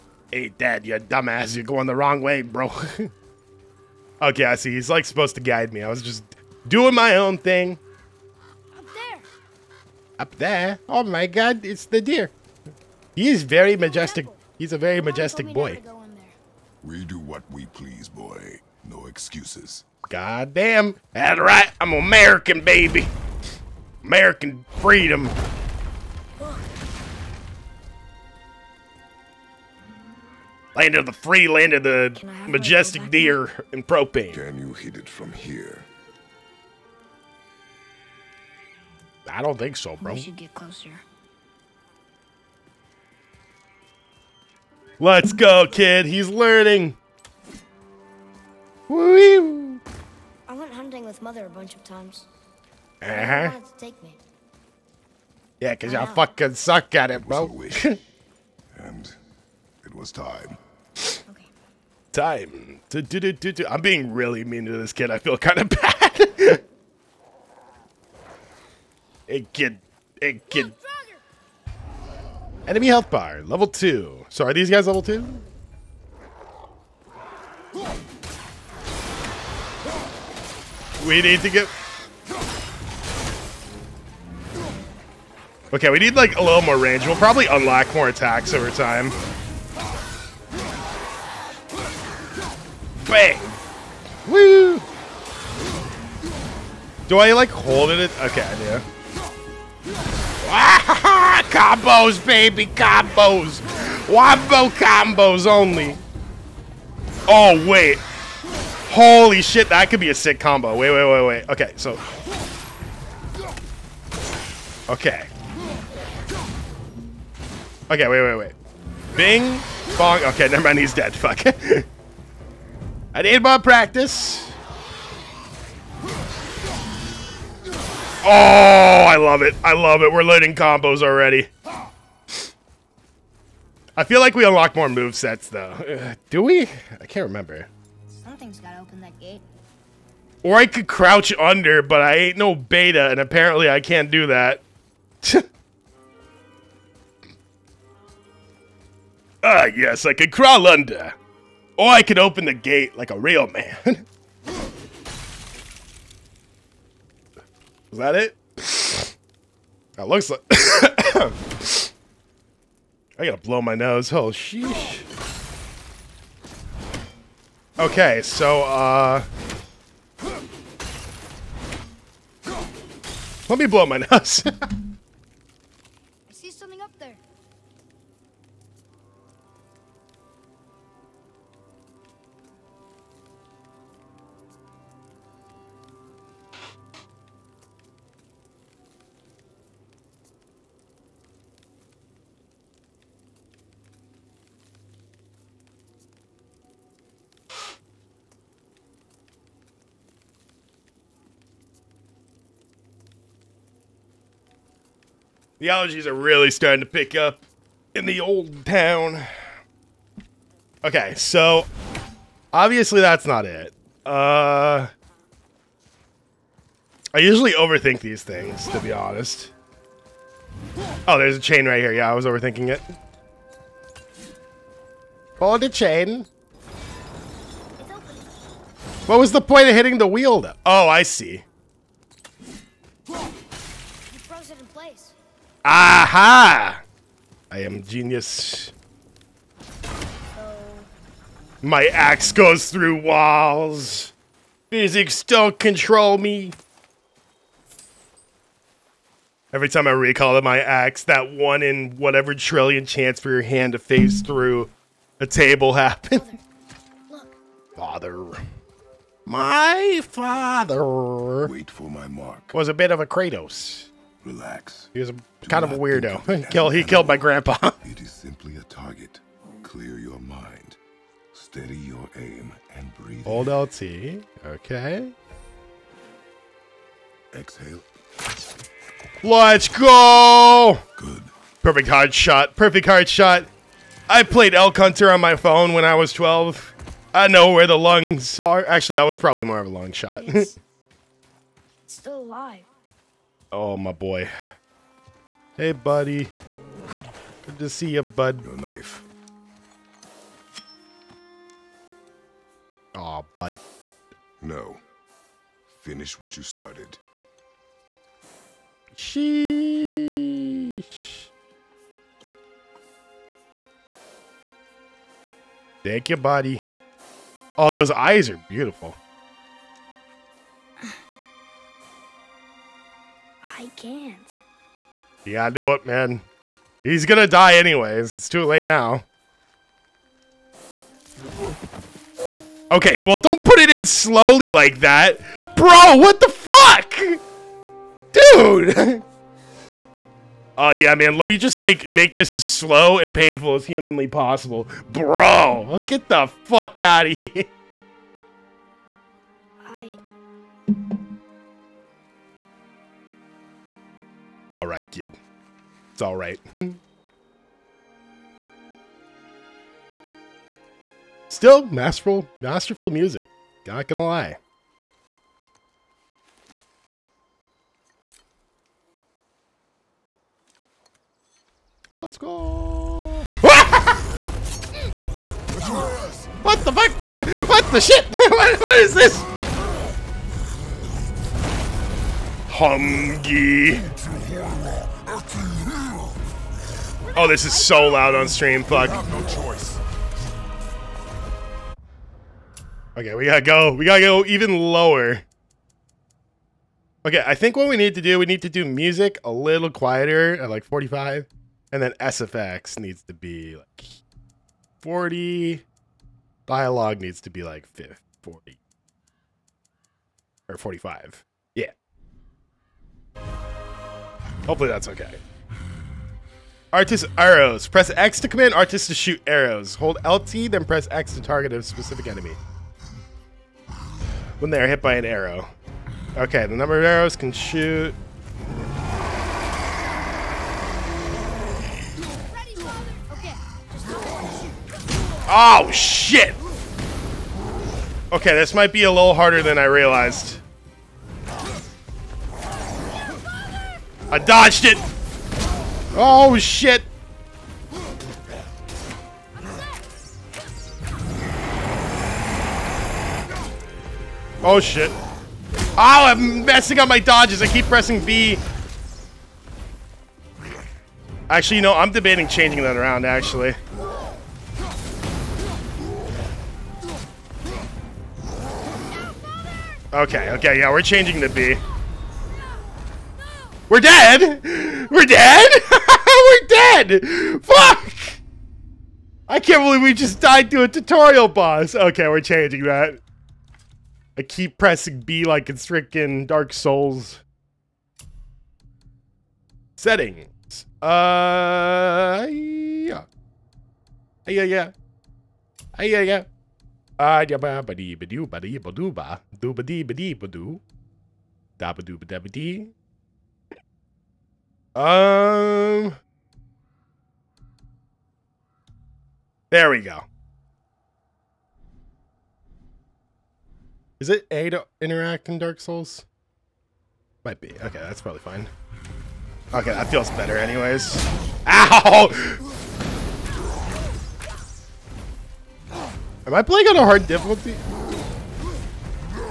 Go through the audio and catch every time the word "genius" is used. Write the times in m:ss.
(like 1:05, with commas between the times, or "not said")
3:57.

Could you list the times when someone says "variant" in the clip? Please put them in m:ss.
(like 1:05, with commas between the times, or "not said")
not said.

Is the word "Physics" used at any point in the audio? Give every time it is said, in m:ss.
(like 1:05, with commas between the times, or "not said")
4:04.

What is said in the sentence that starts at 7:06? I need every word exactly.
Okay, the number of arrows can shoot.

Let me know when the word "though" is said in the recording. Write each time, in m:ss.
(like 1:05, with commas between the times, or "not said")
2:15, 3:50.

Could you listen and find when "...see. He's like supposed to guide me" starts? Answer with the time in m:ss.
0:04.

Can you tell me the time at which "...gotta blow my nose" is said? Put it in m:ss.
2:43.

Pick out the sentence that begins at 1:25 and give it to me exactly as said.
Okay, we need like a little more range.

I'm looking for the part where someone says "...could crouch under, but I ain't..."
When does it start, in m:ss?
2:20.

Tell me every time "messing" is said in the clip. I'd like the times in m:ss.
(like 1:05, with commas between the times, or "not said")
7:36.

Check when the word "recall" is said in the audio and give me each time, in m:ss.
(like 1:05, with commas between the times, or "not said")
4:09.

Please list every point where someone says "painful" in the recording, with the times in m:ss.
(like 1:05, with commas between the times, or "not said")
5:43.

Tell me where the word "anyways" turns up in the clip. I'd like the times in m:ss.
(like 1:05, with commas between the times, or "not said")
5:27, 8:40.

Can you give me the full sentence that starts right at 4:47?
I know where the lungs are.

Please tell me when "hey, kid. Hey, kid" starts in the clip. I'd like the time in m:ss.
1:09.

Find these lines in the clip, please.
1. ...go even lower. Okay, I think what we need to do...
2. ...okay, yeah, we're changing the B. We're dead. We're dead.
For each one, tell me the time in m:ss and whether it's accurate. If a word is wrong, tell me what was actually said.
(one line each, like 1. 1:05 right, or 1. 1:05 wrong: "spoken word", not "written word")
1. 6:33 right
2. 7:50 right.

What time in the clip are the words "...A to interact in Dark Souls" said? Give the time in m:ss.
8:34.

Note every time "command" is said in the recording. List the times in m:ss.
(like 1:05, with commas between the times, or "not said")
6:58.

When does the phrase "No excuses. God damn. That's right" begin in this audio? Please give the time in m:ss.
0:18.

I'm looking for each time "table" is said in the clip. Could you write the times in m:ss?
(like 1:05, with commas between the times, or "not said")
4:15.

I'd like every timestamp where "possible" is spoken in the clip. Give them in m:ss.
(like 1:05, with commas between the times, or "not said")
5:44.